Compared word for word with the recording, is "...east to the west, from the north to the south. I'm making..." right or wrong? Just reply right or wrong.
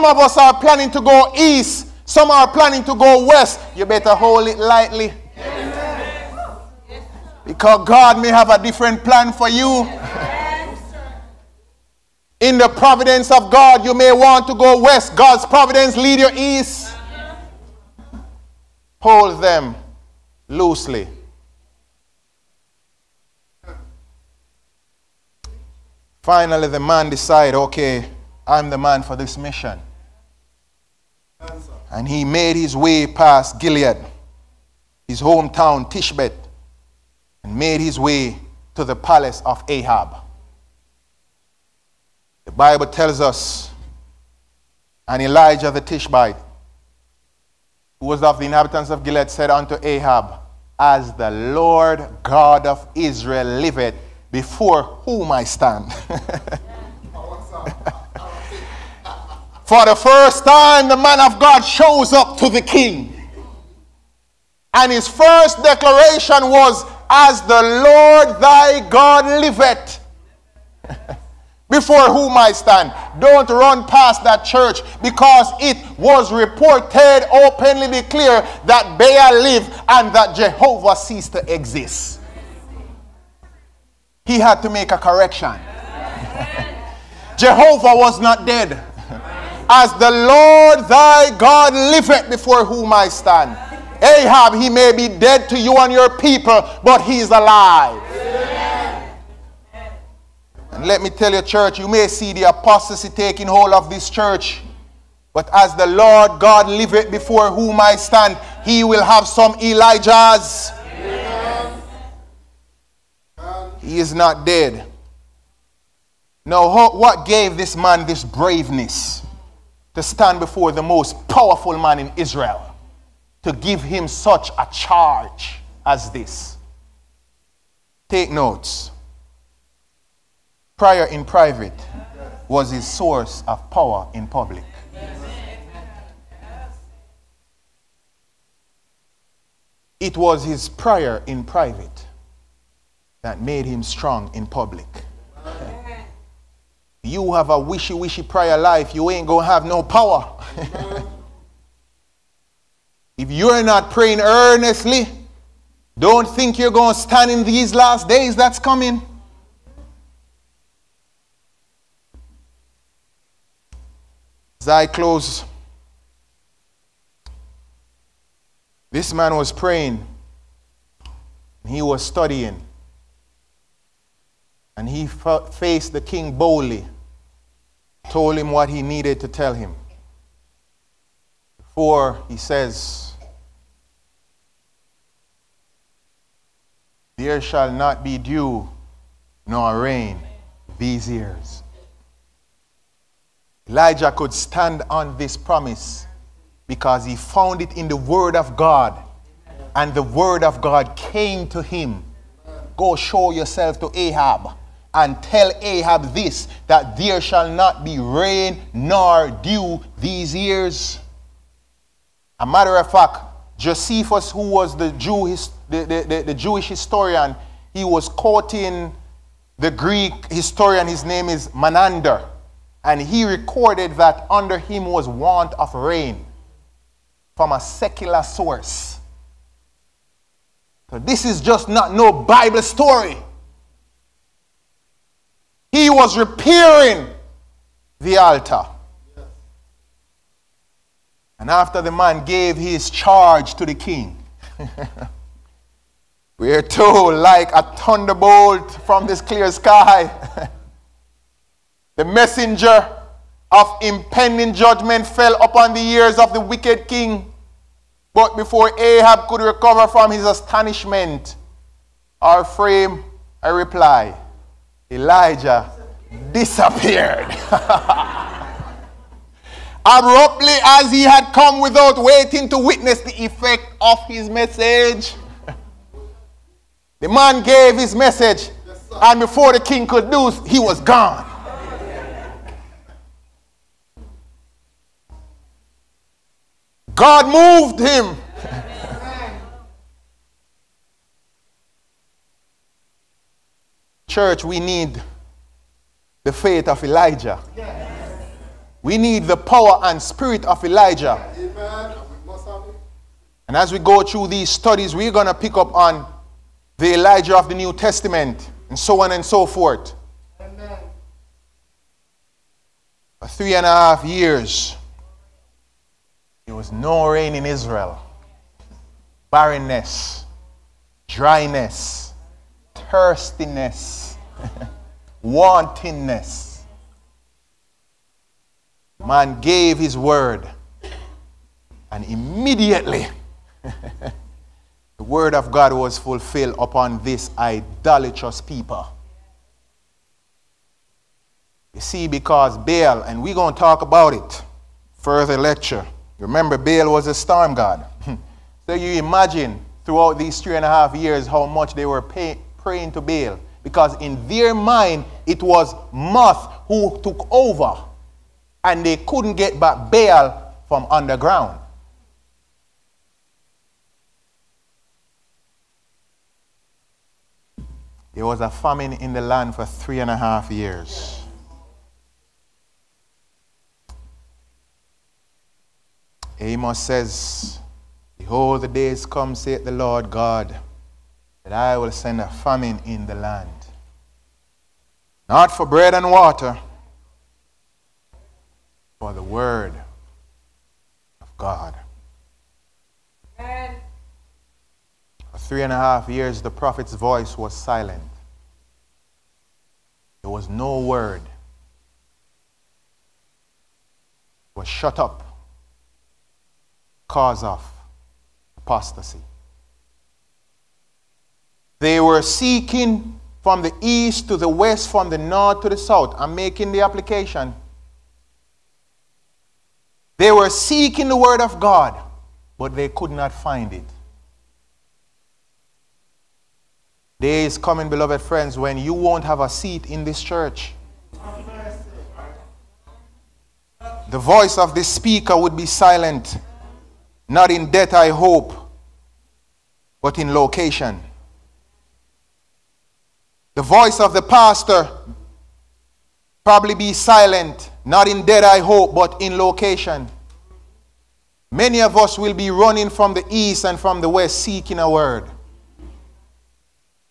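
right.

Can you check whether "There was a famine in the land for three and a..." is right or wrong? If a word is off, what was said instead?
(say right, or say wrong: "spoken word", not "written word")
right.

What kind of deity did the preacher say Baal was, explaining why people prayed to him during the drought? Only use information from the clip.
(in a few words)
storm god.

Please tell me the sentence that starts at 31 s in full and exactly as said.
And he made his way past Gilead, his hometown, Tishbet, and made his way to the palace of Ahab.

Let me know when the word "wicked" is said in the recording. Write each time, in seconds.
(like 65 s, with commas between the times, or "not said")
256 s.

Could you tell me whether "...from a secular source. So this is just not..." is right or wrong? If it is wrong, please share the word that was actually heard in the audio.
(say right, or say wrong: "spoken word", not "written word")
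right.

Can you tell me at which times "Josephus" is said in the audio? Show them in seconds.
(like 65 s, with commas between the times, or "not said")
213 s.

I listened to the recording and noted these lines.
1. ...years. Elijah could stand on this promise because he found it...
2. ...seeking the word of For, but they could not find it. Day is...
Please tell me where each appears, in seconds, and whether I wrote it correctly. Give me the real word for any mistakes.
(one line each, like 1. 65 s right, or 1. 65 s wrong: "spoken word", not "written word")
1. 191 s right
2. 420 s wrong: "God", not "For".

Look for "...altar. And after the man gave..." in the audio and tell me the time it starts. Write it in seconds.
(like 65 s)
238 s.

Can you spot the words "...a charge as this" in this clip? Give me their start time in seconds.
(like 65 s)
124 s.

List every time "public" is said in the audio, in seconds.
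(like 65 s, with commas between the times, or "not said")
134 s, 144 s.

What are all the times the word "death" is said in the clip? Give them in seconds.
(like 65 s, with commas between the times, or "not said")
437 s, 448 s.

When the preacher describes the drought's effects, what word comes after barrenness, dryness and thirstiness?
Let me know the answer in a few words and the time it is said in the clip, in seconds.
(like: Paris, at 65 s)
wantonness, at 325 s.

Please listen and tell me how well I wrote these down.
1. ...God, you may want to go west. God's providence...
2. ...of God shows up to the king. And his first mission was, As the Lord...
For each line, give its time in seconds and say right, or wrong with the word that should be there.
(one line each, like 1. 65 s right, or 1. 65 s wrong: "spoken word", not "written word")
1. 13 s right
2. 61 s wrong: "declaration", not "mission".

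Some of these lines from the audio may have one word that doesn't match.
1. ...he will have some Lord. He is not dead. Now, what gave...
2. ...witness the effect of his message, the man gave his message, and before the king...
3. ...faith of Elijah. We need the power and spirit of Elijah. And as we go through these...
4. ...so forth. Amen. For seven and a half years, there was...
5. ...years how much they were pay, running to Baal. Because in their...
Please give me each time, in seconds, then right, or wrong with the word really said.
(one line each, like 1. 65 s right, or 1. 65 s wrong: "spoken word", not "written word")
1. 108 s wrong: "Elijahs", not "Lord"
2. 272 s right
3. 296 s right
4. 309 s wrong: "three", not "seven"
5. 350 s wrong: "praying", not "running".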